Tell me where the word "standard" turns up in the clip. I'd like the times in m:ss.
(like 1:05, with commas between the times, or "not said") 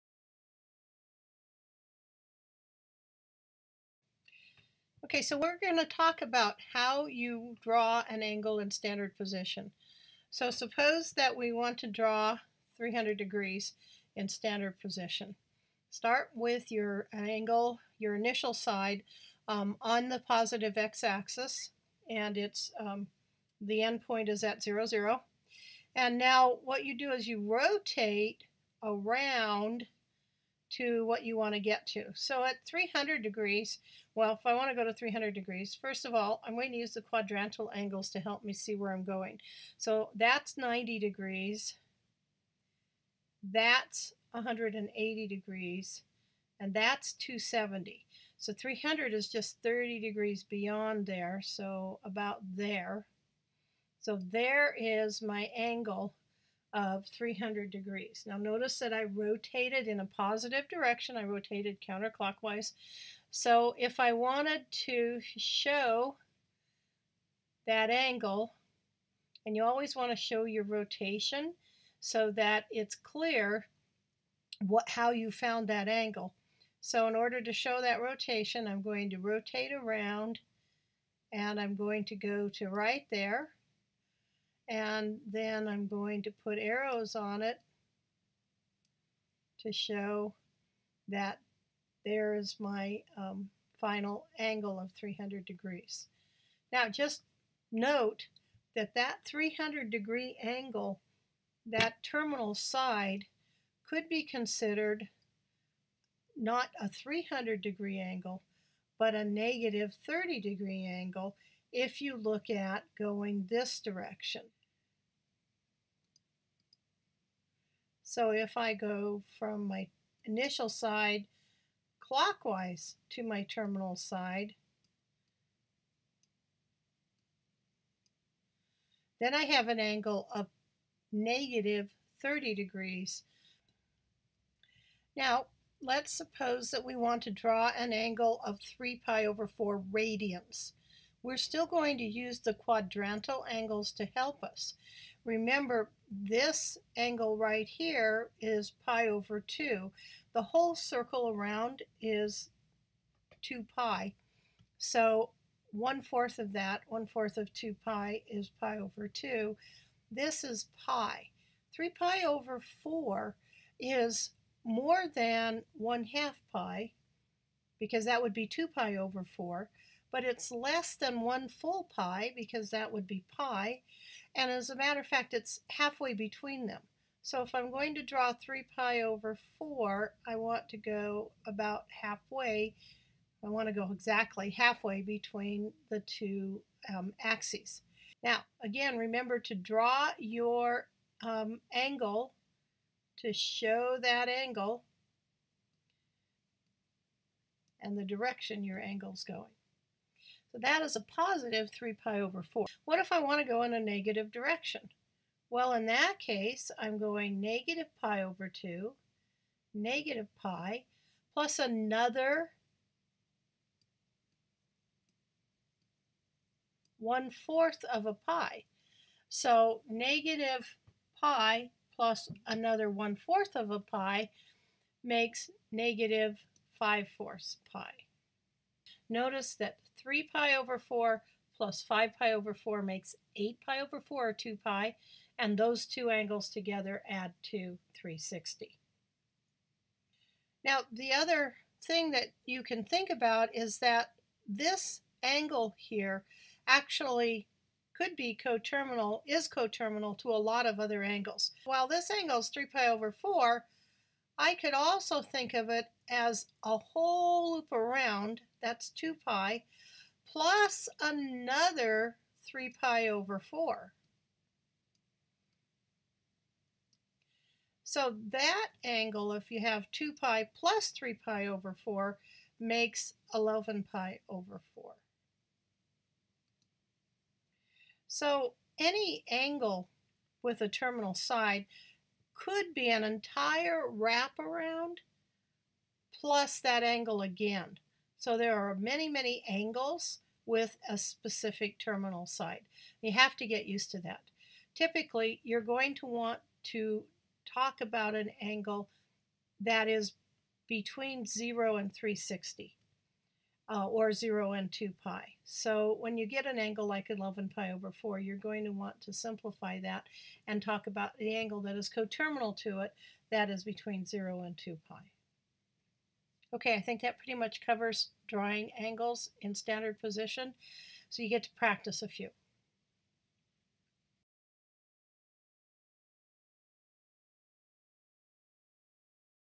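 0:08, 0:14, 5:19.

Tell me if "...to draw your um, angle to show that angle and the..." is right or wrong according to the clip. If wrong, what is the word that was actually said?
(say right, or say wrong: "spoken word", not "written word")
right.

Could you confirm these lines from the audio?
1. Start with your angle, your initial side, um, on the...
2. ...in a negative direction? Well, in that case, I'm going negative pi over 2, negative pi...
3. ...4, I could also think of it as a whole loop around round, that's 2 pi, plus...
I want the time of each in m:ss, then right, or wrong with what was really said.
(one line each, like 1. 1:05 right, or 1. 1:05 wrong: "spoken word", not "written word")
1. 0:15 right
2. 3:23 right
3. 4:13 right.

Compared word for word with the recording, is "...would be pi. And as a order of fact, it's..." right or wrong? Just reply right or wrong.
wrong.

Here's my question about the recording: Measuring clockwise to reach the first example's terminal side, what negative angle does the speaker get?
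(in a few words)
-30 degrees.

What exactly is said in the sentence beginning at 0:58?
Now notice that I rotated in a positive direction.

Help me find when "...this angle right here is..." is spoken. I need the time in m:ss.
2:26.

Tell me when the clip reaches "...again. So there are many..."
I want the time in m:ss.
4:47.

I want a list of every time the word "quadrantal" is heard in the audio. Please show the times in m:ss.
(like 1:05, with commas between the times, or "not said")
0:37, 2:22.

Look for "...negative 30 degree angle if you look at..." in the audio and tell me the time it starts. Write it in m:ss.
1:49.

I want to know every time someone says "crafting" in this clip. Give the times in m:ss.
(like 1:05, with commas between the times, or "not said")
not said.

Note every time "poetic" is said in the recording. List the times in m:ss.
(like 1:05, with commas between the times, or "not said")
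not said.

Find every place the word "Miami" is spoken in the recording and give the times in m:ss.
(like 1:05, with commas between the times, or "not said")
not said.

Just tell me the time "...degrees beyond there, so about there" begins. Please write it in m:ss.
0:49.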